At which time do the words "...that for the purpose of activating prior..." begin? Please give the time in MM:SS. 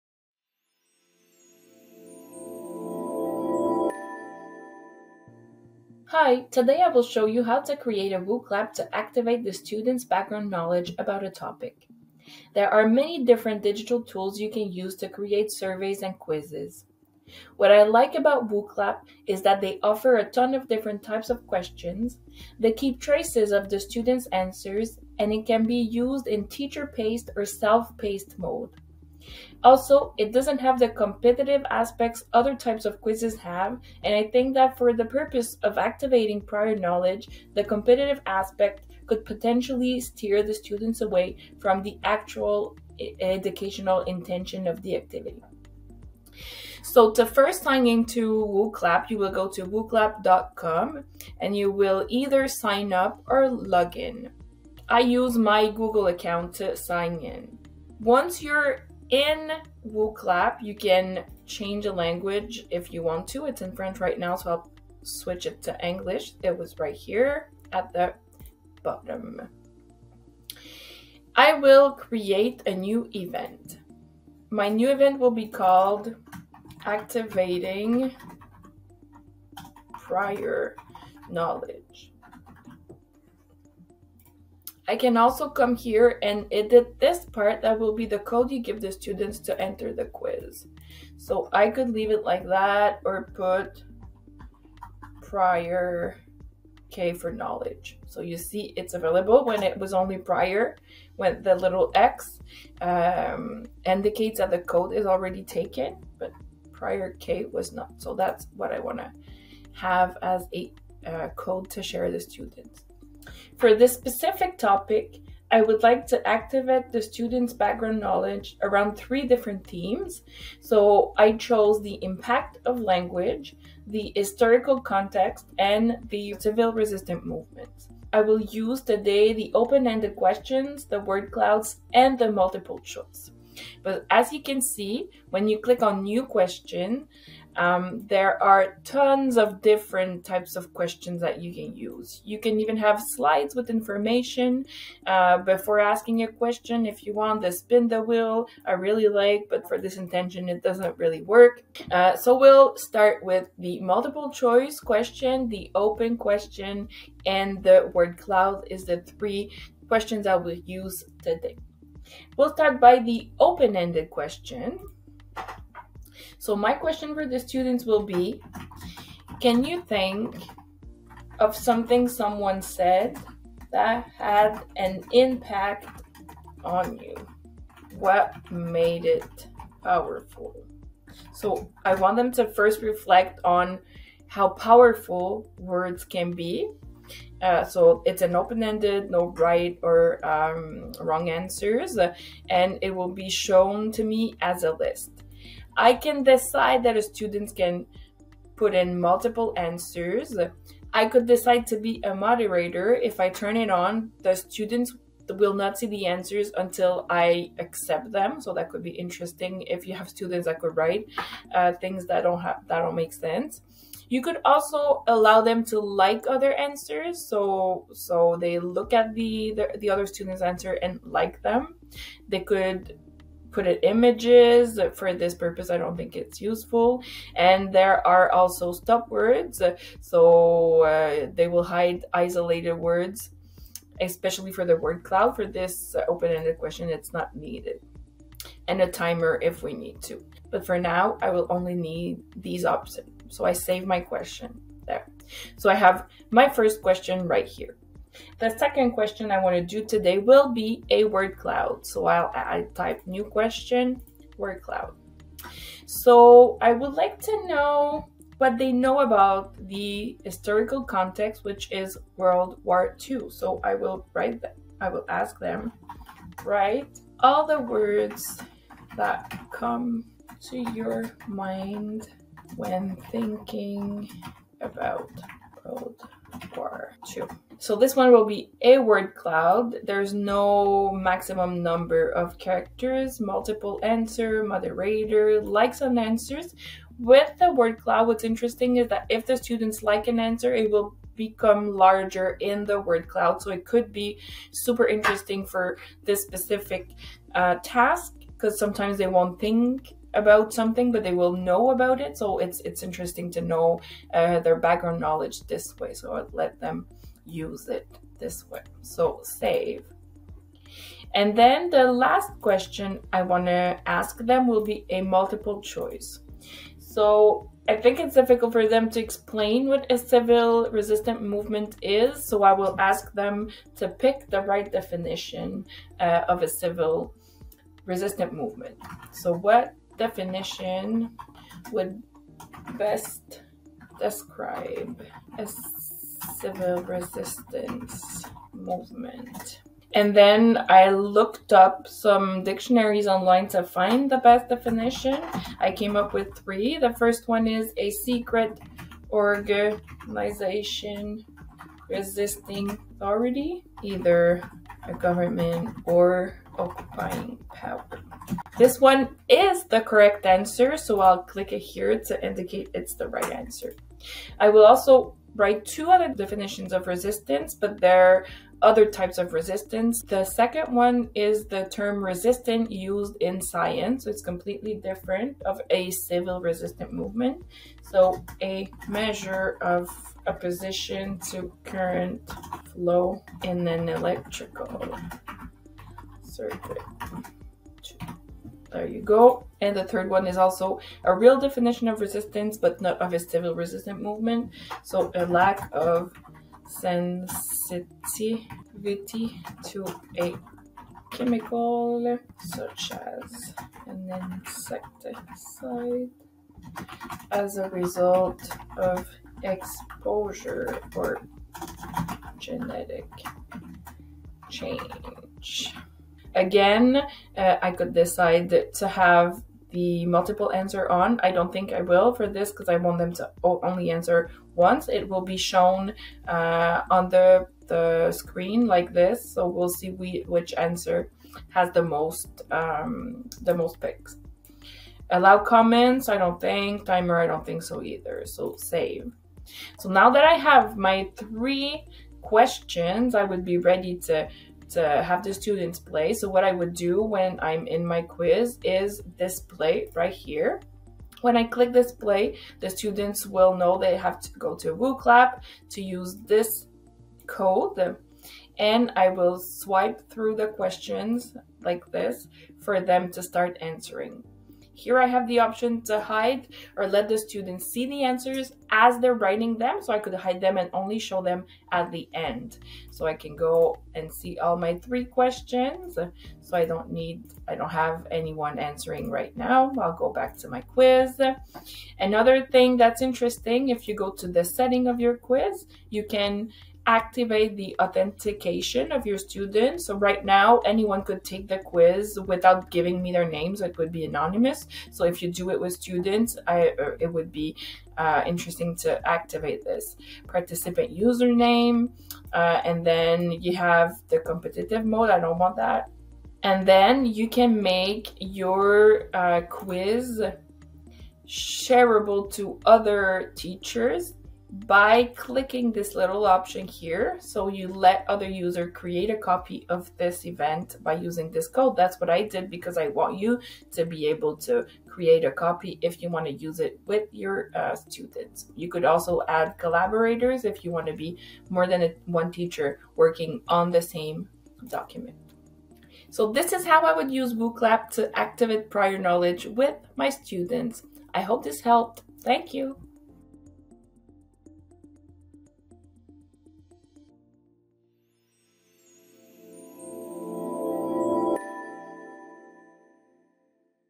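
00:34.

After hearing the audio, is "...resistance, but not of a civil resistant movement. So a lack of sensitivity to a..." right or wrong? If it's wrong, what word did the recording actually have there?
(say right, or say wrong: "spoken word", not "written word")
right.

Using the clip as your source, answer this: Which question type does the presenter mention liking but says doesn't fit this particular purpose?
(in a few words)
spin the wheel.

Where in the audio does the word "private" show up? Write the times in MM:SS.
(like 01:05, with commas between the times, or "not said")
not said.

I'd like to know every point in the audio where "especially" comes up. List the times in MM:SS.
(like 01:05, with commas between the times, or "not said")
03:54.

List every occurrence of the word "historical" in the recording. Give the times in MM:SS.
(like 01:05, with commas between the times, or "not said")
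02:04, 04:20.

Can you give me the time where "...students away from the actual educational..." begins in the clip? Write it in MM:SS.
00:40.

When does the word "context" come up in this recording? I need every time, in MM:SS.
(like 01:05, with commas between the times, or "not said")
02:04, 04:20.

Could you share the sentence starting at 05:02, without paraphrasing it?
So it's it's interesting to know uh, their background knowledge this way.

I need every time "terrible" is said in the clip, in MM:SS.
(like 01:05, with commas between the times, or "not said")
not said.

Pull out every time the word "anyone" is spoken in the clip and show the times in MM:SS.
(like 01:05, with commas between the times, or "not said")
07:58, 08:10.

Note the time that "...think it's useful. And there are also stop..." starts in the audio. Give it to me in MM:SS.
03:45.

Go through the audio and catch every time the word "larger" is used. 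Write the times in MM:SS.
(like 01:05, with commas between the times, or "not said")
04:51.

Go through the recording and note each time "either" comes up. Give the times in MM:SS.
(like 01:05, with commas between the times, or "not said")
00:52, 05:53, 07:17.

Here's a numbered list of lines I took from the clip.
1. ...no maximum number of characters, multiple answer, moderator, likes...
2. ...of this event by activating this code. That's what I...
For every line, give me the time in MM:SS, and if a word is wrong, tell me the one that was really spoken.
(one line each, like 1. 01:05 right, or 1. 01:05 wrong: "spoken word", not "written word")
1. 04:40 right
2. 08:39 wrong: "using", not "activating".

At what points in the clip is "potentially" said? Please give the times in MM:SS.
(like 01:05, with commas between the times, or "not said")
00:39.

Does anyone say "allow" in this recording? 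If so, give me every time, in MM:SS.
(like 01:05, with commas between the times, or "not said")
03:35, 07:15.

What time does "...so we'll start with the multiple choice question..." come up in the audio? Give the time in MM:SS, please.
02:32.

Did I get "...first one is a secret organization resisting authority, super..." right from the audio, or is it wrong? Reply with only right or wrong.
wrong.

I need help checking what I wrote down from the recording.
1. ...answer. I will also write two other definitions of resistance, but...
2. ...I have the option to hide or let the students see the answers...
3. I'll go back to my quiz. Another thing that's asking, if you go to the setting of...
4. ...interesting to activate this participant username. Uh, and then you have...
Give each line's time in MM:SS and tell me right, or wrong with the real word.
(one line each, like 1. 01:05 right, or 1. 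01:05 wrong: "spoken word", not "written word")
1. 06:03 right
2. 07:44 right
3. 07:59 wrong: "interesting", not "asking"
4. 08:18 right.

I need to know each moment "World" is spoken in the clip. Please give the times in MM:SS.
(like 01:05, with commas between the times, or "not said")
04:22, 04:35.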